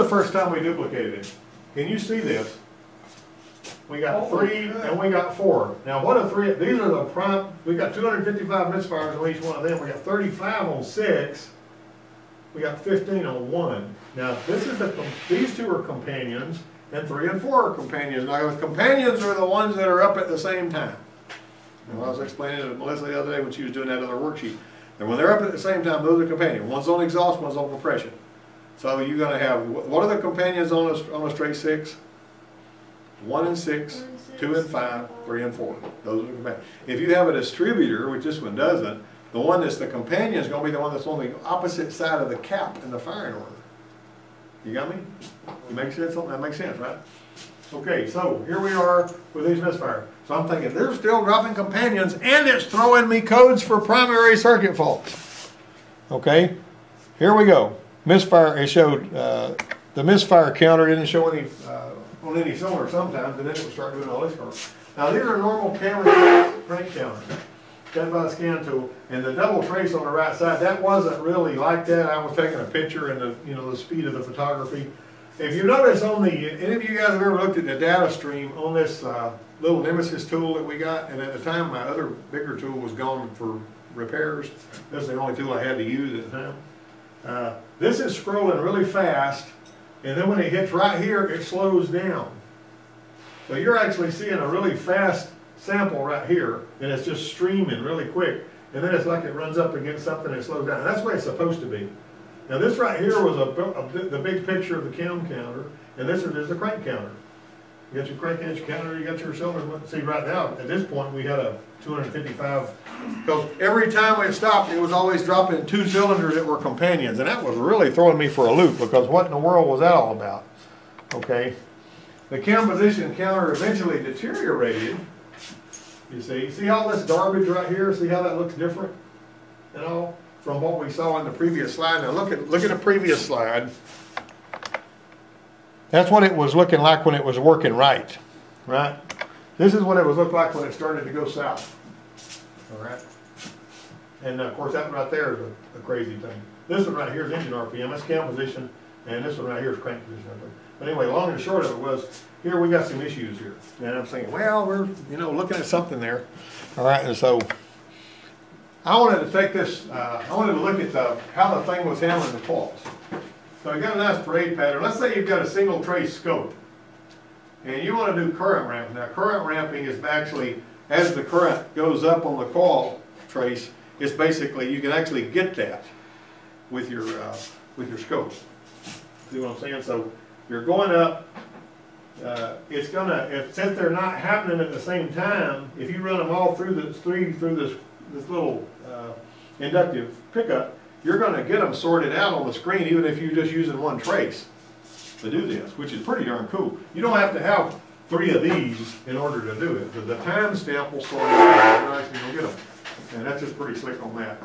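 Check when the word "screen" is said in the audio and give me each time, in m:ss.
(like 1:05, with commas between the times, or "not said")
3:12.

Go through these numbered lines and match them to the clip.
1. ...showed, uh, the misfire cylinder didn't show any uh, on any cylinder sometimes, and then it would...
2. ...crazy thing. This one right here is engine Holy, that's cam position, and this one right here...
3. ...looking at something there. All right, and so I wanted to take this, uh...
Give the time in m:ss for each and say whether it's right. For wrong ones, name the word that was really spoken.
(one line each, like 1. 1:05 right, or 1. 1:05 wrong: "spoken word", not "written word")
1. 0:58 wrong: "counter", not "cylinder"
2. 2:25 wrong: "RPM", not "Holy"
3. 2:35 right.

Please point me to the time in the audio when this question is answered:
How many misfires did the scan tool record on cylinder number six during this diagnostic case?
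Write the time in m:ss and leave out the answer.
0:09.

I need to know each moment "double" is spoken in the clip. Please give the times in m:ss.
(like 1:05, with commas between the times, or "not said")
1:09.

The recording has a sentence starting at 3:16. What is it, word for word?
You don't have to have three of these in order to do it.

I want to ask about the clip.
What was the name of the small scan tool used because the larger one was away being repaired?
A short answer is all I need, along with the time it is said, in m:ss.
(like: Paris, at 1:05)
Nemesis, at 1:19.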